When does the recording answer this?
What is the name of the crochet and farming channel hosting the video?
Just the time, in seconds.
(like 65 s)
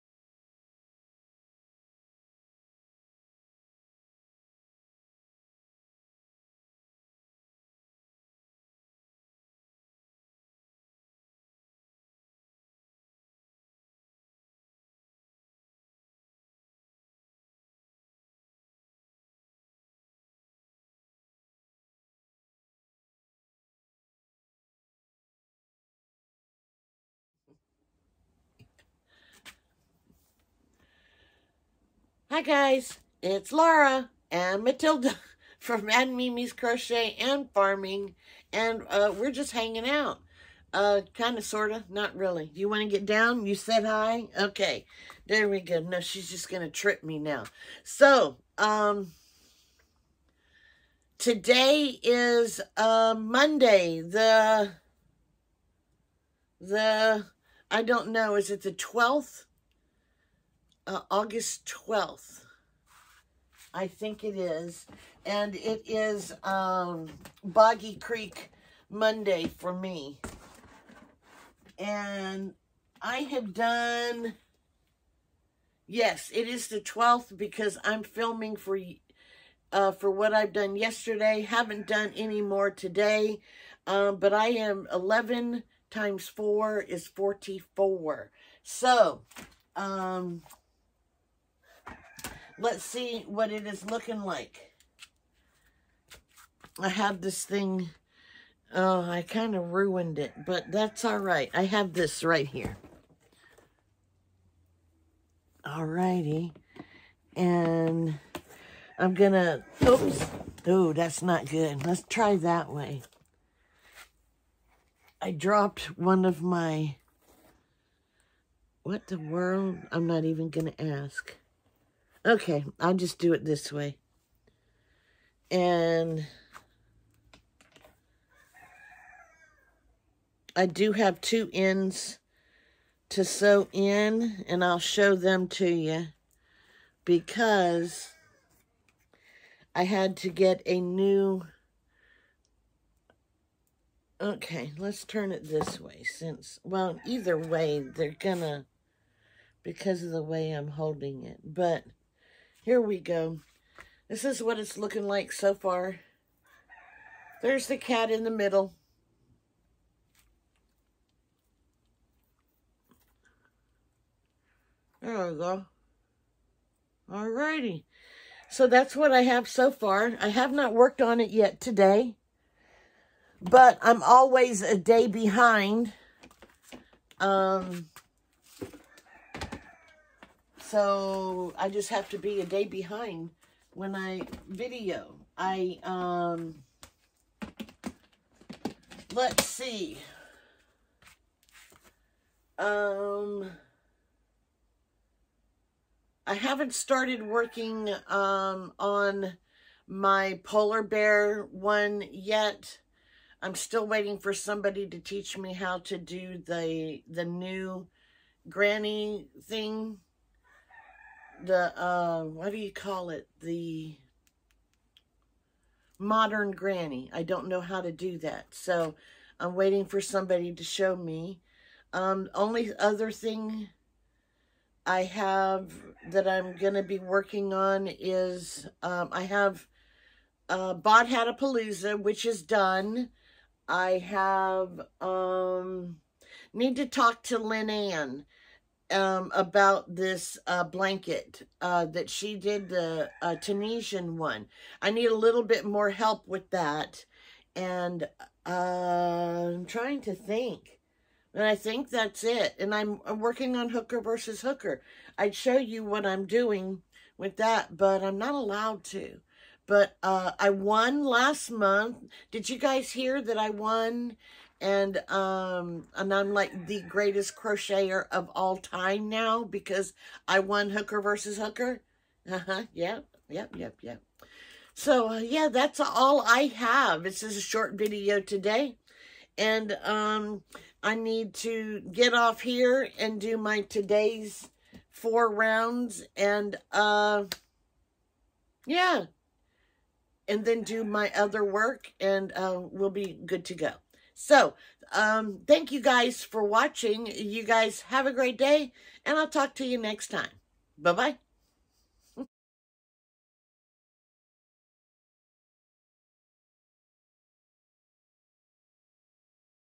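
35 s.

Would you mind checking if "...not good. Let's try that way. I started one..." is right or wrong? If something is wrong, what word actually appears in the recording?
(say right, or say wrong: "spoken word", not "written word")
wrong: "dropped", not "started".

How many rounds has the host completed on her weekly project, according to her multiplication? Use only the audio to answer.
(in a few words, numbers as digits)
44.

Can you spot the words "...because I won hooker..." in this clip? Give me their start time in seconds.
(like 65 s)
269 s.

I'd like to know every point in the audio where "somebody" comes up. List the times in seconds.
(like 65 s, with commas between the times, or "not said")
204 s, 220 s.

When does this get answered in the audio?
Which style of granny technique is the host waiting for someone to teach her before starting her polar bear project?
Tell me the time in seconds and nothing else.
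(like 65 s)
215 s.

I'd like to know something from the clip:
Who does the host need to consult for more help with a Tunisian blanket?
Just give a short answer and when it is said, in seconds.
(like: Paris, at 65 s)
Lynn Ann, at 237 s.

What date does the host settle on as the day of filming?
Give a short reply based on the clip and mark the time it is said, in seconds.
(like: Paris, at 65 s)
August 12th, at 61 s.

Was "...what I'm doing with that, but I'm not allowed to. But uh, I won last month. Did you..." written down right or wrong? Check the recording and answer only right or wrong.
right.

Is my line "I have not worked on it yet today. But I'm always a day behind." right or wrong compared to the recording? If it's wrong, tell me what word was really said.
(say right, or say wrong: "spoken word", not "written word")
right.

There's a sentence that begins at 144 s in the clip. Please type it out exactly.
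Okay, let's turn it this way since, well, either way, they're gonna, because of the way I'm holding it, but...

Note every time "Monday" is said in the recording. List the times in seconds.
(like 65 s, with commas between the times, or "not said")
53 s, 68 s.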